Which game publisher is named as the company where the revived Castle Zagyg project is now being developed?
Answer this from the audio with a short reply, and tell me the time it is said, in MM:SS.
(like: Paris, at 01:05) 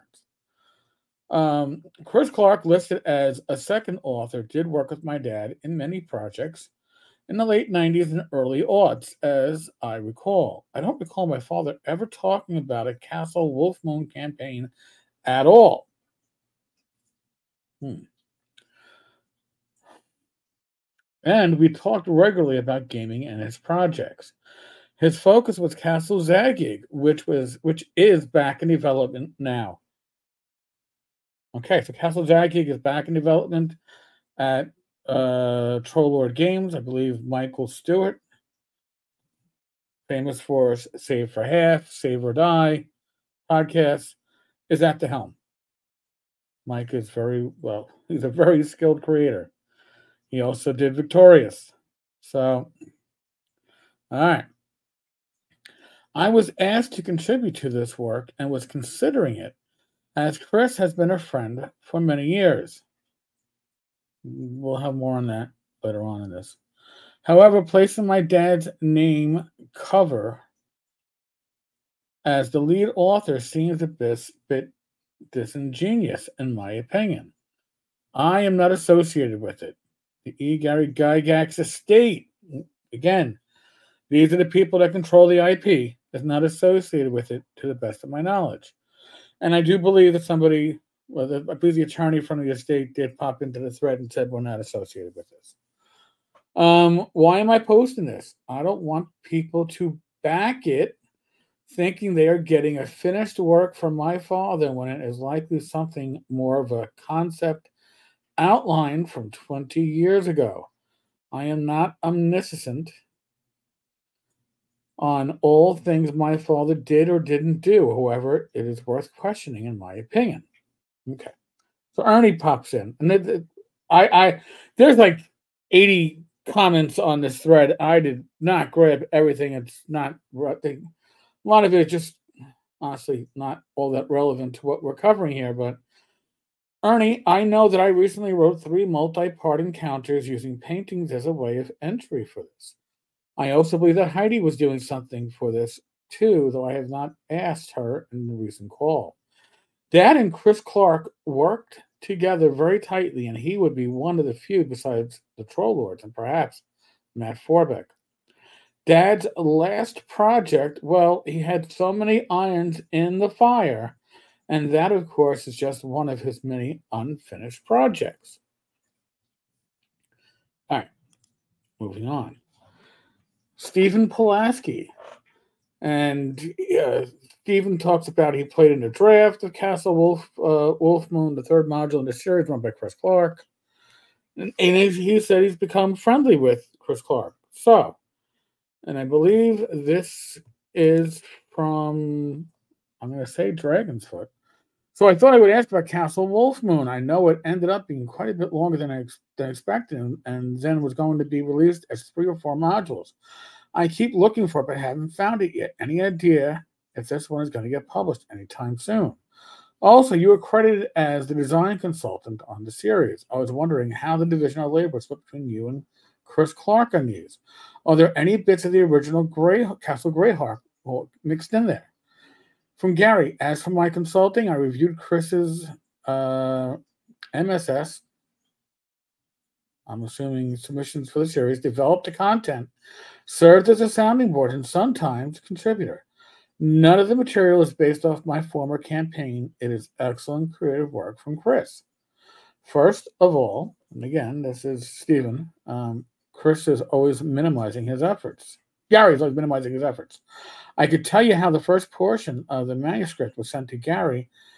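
Troll Lord Games, at 00:35.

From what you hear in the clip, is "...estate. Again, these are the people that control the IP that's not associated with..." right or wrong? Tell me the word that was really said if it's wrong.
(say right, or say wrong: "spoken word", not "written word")
right.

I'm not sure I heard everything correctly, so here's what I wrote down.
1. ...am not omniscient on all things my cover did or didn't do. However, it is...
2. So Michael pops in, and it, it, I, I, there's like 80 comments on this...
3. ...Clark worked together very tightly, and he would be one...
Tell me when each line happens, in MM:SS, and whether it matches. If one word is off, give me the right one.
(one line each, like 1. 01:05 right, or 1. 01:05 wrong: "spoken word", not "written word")
1. 01:51 wrong: "father", not "cover"
2. 02:01 wrong: "Ernie", not "Michael"
3. 02:30 right.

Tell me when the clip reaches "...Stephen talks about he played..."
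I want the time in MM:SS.
02:57.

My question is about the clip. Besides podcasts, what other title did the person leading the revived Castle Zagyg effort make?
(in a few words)
Victorious.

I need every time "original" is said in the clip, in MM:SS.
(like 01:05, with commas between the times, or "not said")
03:38.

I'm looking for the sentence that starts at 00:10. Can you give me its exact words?
I don't recall my father ever talking about a Castle Wolfmoon campaign at all.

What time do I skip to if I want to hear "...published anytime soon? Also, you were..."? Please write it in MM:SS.
03:27.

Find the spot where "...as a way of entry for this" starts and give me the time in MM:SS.
02:21.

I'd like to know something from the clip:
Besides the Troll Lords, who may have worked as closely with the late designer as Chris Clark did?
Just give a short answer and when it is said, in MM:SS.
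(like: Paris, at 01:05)
Matt Forbeck, at 02:37.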